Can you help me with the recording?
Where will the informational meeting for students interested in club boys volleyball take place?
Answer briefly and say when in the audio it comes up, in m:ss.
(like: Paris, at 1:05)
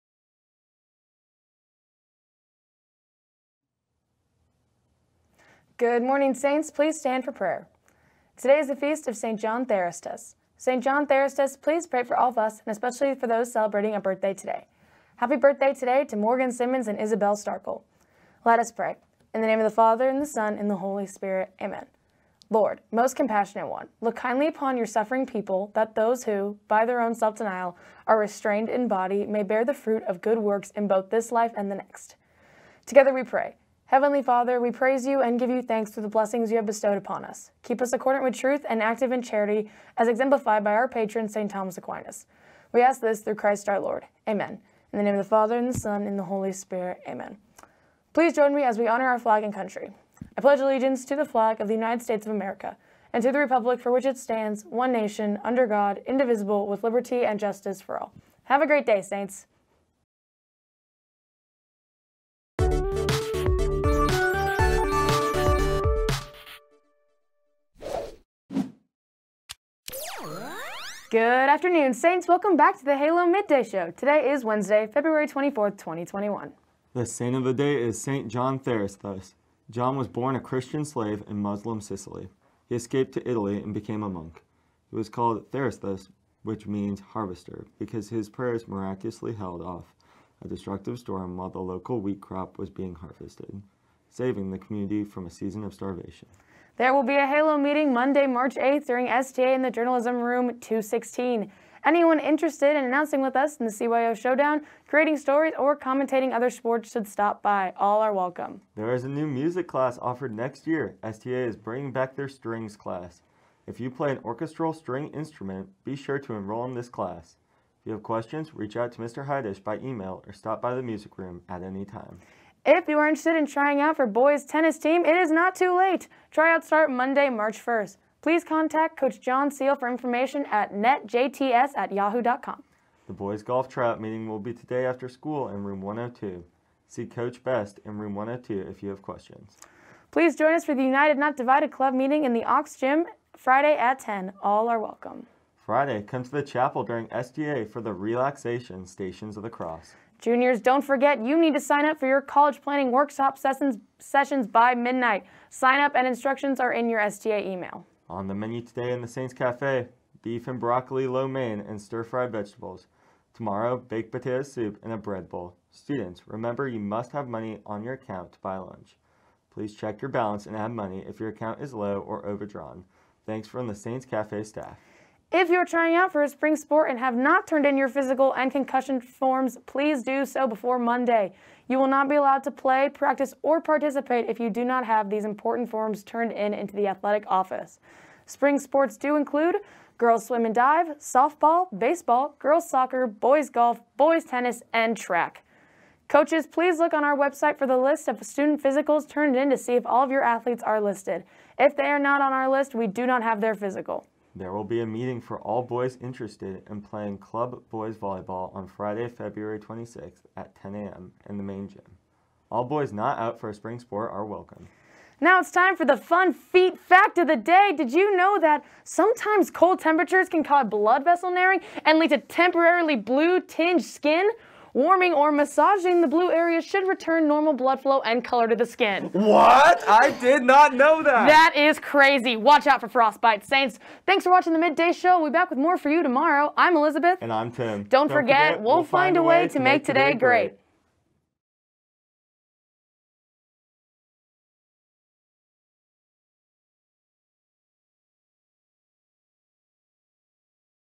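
main gym, at 3:31.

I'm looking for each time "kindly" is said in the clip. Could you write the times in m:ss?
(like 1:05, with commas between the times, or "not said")
0:24.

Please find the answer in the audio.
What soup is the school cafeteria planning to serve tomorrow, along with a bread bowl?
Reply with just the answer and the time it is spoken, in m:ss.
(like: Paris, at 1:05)
baked potato soup, at 2:43.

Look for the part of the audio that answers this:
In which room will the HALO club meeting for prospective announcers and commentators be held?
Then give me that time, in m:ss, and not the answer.
1:39.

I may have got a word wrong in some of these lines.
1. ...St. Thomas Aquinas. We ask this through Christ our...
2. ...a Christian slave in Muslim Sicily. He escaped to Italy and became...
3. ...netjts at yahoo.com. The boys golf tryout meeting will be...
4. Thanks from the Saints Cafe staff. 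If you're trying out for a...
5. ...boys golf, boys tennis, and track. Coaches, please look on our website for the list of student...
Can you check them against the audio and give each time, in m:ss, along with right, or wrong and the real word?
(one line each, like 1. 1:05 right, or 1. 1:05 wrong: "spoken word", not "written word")
1. 0:41 right
2. 1:20 right
3. 2:10 right
4. 2:53 right
5. 3:13 right.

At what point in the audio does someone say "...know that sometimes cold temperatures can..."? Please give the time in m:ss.
3:38.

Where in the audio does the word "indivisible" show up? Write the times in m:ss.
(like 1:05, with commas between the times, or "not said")
0:56.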